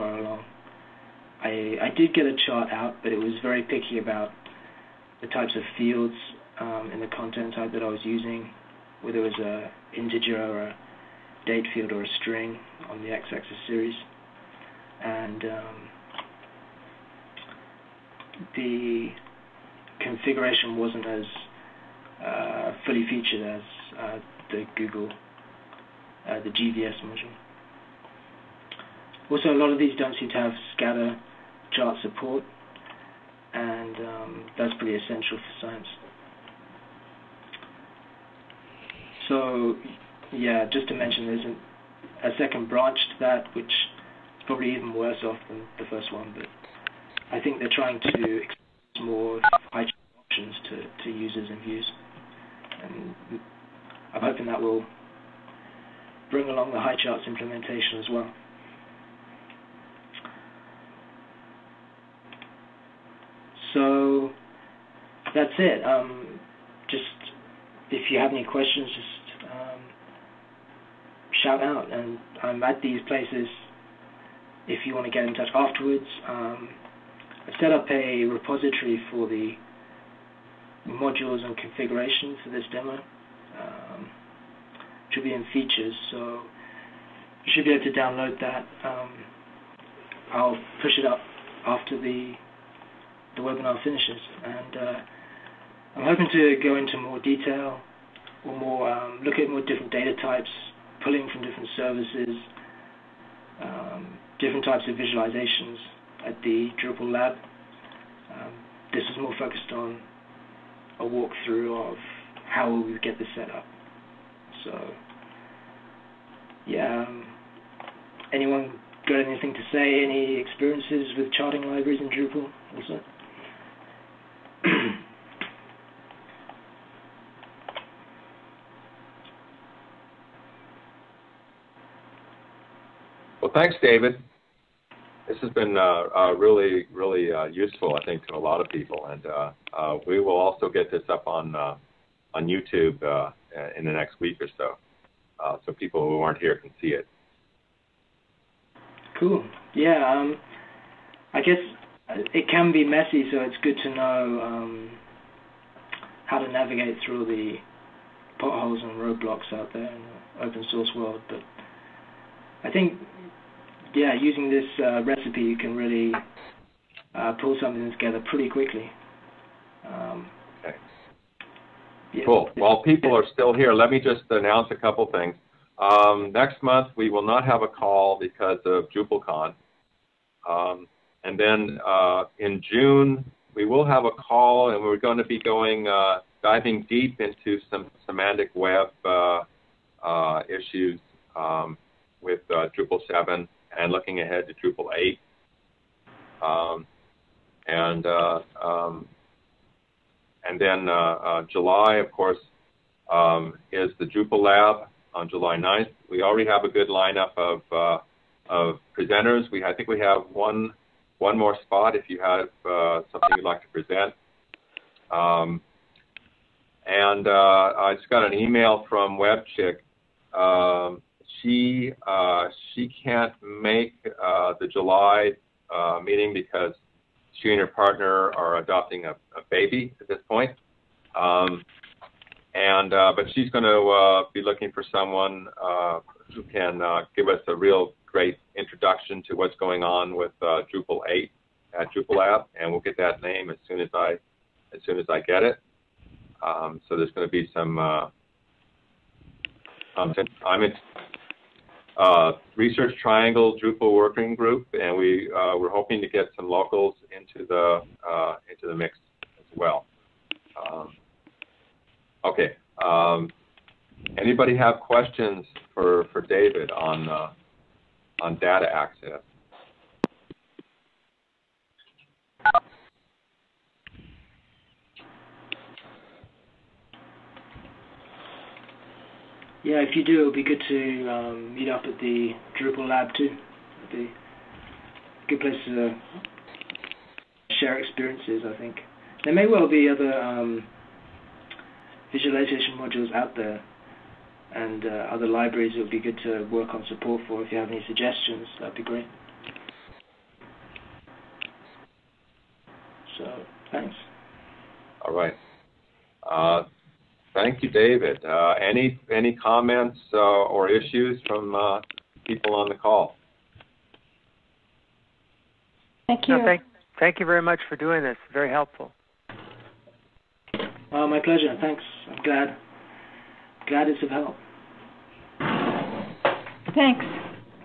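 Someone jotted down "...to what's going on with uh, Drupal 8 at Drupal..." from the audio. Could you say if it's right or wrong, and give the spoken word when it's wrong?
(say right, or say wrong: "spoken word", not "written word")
right.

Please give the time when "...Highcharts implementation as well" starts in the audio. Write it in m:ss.
0:56.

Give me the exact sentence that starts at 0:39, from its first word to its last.
So yeah, just to mention, there's a, a second branch to that, which is probably even worse off than the first one.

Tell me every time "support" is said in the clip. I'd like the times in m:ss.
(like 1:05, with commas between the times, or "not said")
0:32, 4:56.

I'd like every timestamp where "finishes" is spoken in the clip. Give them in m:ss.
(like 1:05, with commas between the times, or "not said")
1:33.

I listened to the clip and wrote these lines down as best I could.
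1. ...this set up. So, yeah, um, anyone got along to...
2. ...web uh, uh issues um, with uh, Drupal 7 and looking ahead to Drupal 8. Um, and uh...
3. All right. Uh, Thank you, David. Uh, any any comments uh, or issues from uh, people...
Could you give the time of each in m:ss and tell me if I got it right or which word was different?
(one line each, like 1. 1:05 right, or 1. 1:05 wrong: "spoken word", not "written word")
1. 1:53 wrong: "anything", not "along"
2. 3:08 right
3. 5:05 right.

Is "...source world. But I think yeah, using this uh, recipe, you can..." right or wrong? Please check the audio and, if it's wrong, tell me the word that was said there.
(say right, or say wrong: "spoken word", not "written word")
right.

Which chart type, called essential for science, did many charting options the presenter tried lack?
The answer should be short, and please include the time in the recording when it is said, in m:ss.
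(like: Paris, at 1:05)
Scatter chart, at 0:30.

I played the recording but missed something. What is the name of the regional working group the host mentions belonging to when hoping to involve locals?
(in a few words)
Research Triangle Drupal Working Group.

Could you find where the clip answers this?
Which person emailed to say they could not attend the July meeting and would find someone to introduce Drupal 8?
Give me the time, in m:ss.
3:39.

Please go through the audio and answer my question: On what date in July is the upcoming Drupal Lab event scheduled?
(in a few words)
July 9.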